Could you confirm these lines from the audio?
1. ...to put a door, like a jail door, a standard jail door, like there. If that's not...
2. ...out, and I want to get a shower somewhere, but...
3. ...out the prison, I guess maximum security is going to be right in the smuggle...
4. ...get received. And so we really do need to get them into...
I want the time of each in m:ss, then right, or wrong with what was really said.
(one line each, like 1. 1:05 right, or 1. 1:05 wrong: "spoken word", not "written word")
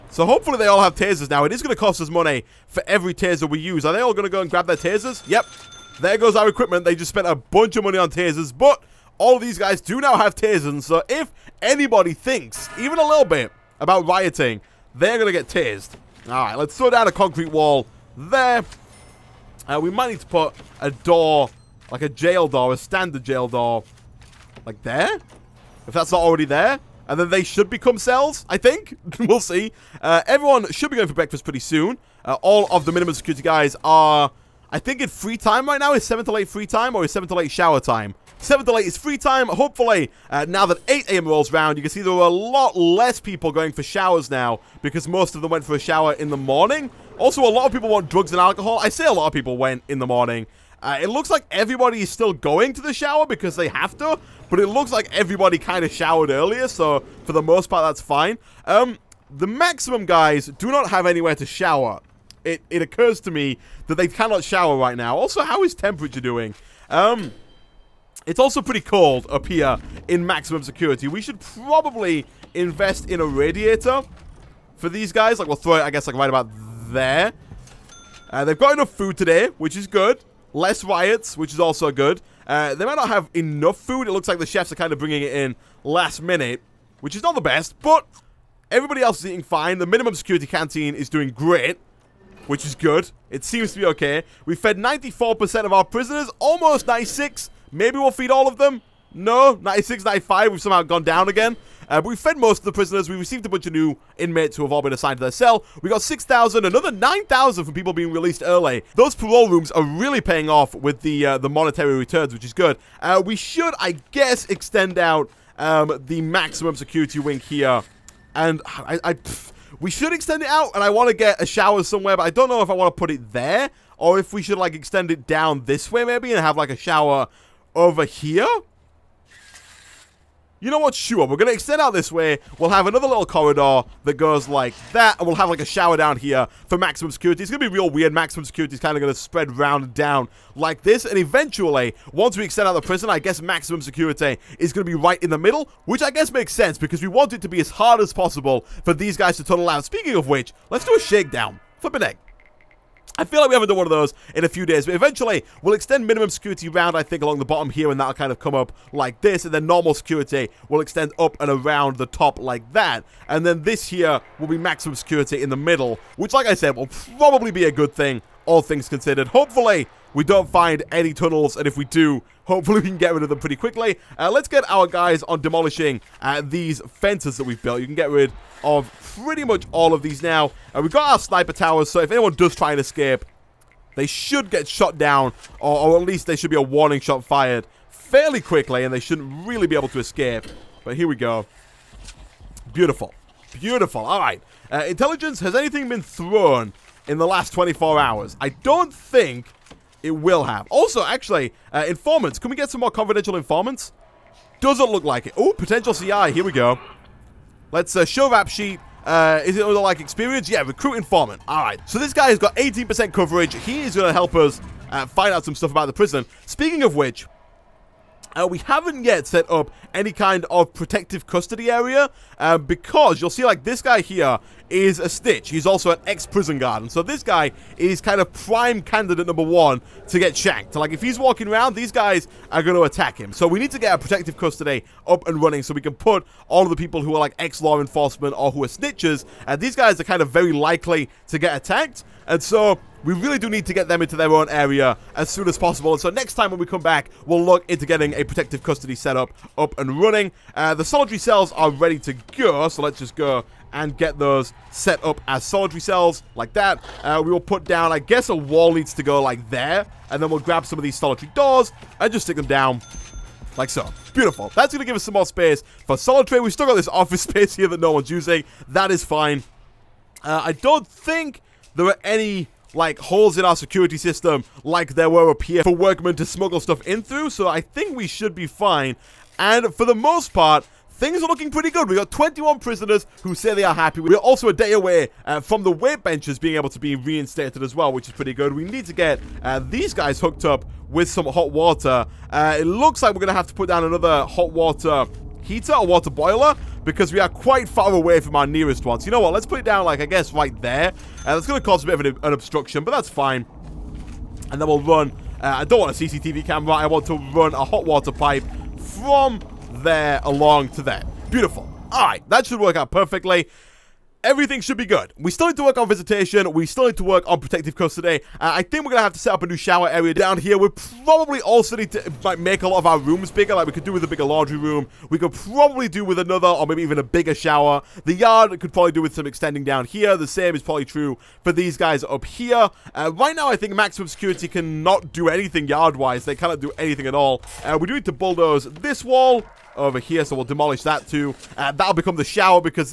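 1. 0:20 right
2. 2:00 right
3. 2:22 wrong: "middle", not "smuggle"
4. 4:01 wrong: "attacked", not "received".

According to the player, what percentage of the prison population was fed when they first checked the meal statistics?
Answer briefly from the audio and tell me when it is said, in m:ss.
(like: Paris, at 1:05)
94%, at 1:34.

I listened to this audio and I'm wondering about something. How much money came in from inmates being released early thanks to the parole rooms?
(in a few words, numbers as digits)
9,000.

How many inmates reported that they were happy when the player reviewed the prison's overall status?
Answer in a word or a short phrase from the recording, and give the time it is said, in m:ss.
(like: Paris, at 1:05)
21, at 4:42.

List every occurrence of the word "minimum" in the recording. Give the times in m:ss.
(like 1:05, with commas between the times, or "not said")
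0:32, 1:29, 2:36.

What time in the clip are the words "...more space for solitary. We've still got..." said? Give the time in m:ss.
4:25.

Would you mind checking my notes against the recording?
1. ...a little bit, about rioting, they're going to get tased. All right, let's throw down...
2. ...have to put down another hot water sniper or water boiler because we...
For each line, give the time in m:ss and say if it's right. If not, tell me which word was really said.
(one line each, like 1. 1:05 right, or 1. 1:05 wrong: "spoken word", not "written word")
1. 0:12 right
2. 4:53 wrong: "heater", not "sniper".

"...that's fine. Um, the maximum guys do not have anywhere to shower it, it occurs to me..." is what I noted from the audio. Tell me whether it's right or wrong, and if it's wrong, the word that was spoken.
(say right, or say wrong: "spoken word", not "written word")
right.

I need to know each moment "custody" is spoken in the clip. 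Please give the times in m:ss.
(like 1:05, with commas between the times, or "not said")
3:41, 3:54, 4:08, 5:17.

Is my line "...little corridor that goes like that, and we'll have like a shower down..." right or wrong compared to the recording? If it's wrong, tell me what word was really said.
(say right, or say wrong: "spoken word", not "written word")
right.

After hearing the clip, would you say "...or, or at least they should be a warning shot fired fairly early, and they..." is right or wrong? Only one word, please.
wrong.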